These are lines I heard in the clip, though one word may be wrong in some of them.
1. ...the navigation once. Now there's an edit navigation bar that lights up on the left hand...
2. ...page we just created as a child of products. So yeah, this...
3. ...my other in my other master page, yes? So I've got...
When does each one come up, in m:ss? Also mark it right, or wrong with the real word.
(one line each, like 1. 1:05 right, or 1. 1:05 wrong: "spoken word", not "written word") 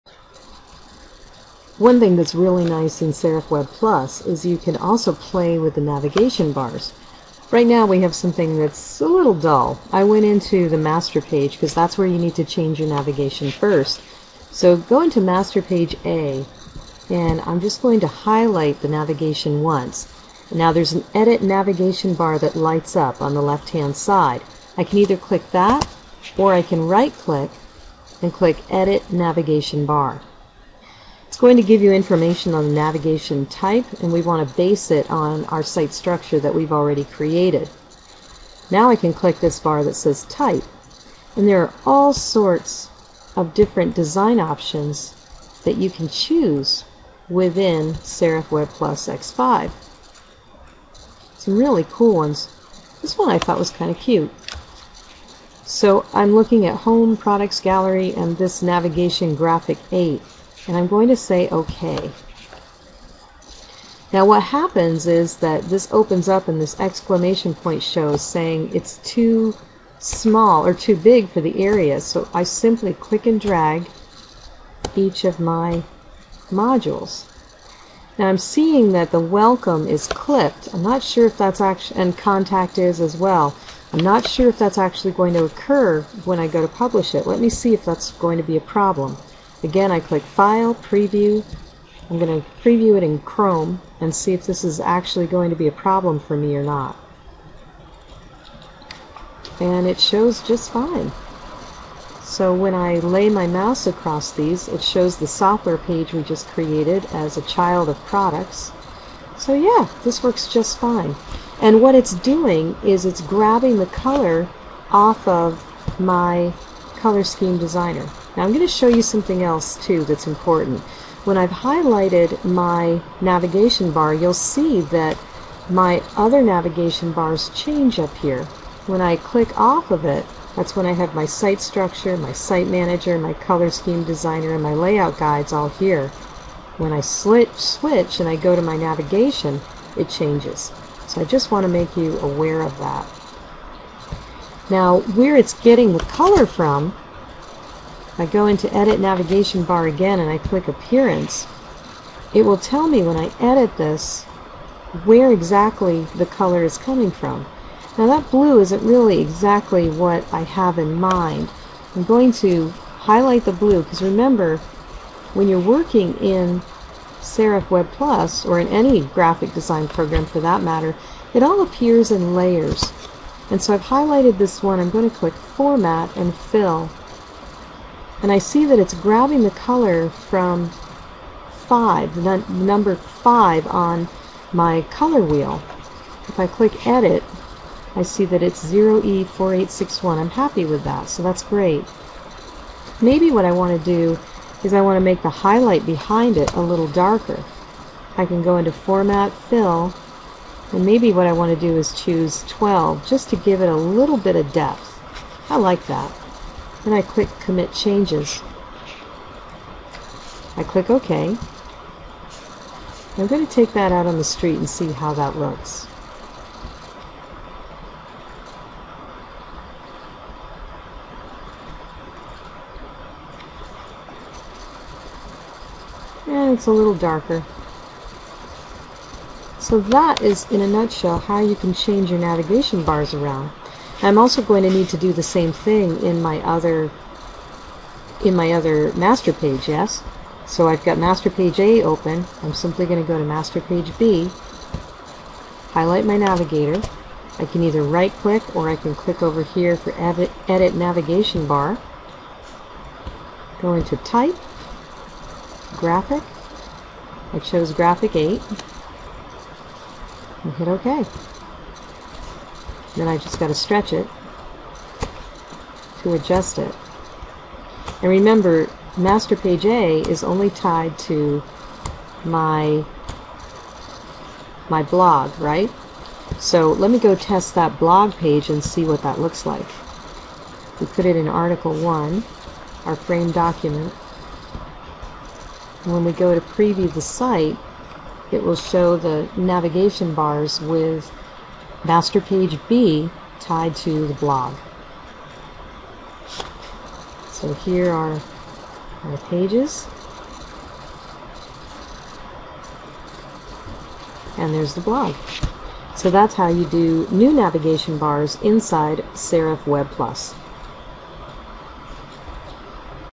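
1. 0:18 right
2. 1:45 right
3. 3:56 right.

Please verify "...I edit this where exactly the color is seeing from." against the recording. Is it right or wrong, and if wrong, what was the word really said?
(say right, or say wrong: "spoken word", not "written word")
wrong: "coming", not "seeing".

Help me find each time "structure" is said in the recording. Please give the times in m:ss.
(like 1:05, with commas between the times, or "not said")
0:35, 2:11.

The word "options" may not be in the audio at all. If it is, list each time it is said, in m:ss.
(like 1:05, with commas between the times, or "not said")
0:44.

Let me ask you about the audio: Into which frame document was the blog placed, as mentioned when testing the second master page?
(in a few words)
Article 1.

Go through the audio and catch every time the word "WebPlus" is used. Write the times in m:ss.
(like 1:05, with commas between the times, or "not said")
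0:03, 0:48, 2:47, 5:09.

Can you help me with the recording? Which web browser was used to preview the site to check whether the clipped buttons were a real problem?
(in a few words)
Chrome.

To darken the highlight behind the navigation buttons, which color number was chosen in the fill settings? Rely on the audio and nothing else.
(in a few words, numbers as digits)
12.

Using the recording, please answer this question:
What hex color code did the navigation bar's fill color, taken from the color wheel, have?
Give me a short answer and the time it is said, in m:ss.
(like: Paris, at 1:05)
0E4861, at 3:08.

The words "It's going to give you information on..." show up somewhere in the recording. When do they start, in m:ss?
0:31.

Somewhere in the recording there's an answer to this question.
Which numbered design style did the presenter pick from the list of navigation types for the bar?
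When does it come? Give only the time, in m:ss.
0:58.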